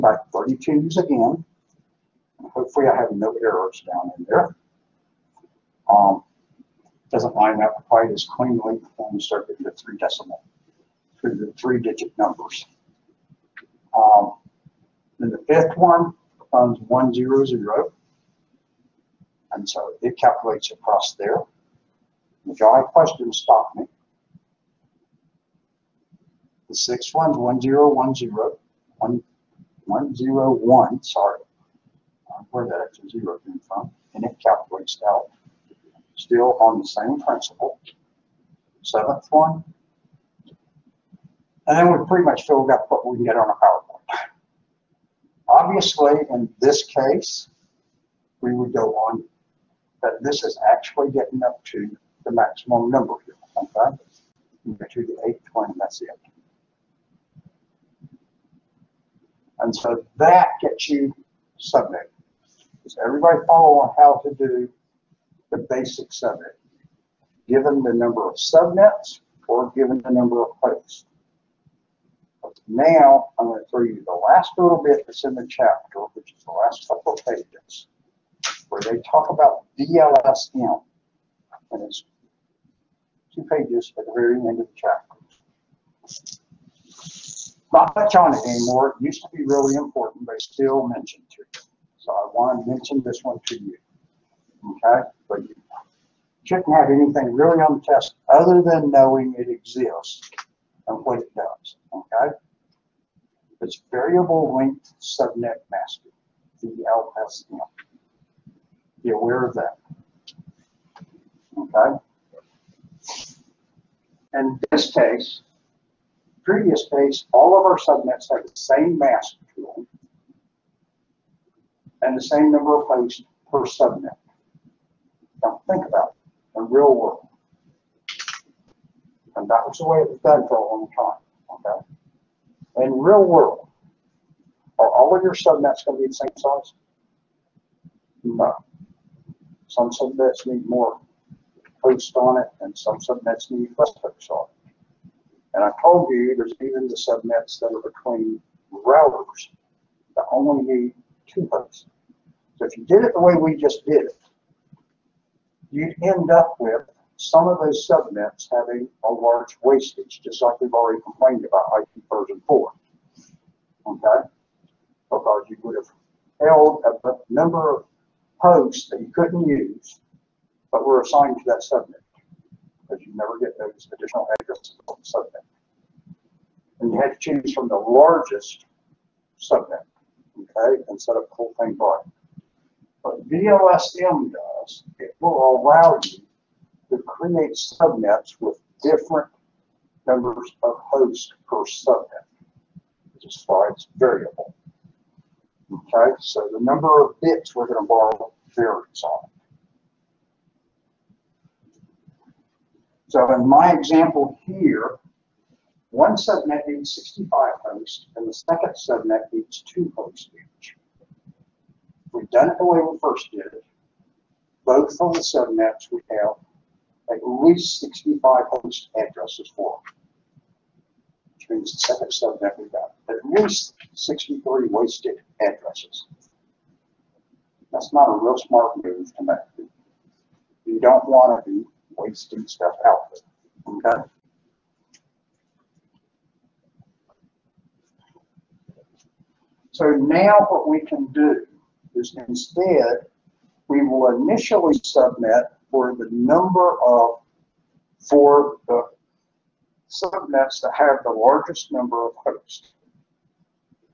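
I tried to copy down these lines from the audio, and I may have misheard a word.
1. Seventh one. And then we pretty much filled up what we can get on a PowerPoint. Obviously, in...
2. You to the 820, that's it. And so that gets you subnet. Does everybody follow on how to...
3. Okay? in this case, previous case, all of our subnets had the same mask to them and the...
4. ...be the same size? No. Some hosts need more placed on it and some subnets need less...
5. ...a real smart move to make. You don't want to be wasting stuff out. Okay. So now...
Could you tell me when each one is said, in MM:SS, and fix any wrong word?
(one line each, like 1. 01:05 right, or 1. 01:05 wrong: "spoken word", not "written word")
1. 00:38 right
2. 00:54 right
3. 01:51 right
4. 02:16 wrong: "subnets", not "hosts"
5. 03:48 right.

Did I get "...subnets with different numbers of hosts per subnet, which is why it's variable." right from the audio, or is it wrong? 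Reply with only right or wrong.
right.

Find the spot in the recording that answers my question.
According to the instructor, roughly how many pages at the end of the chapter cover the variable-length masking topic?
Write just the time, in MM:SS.
01:23.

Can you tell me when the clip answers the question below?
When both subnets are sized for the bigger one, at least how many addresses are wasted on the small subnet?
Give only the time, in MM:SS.
03:43.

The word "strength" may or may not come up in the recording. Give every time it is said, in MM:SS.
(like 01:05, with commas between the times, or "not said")
not said.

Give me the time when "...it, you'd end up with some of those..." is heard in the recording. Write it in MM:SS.
02:34.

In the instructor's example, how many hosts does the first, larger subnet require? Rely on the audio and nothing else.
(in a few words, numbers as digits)
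65.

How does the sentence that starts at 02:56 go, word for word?
And you had to choose from the largest subnet, okay, and set up the whole thing by.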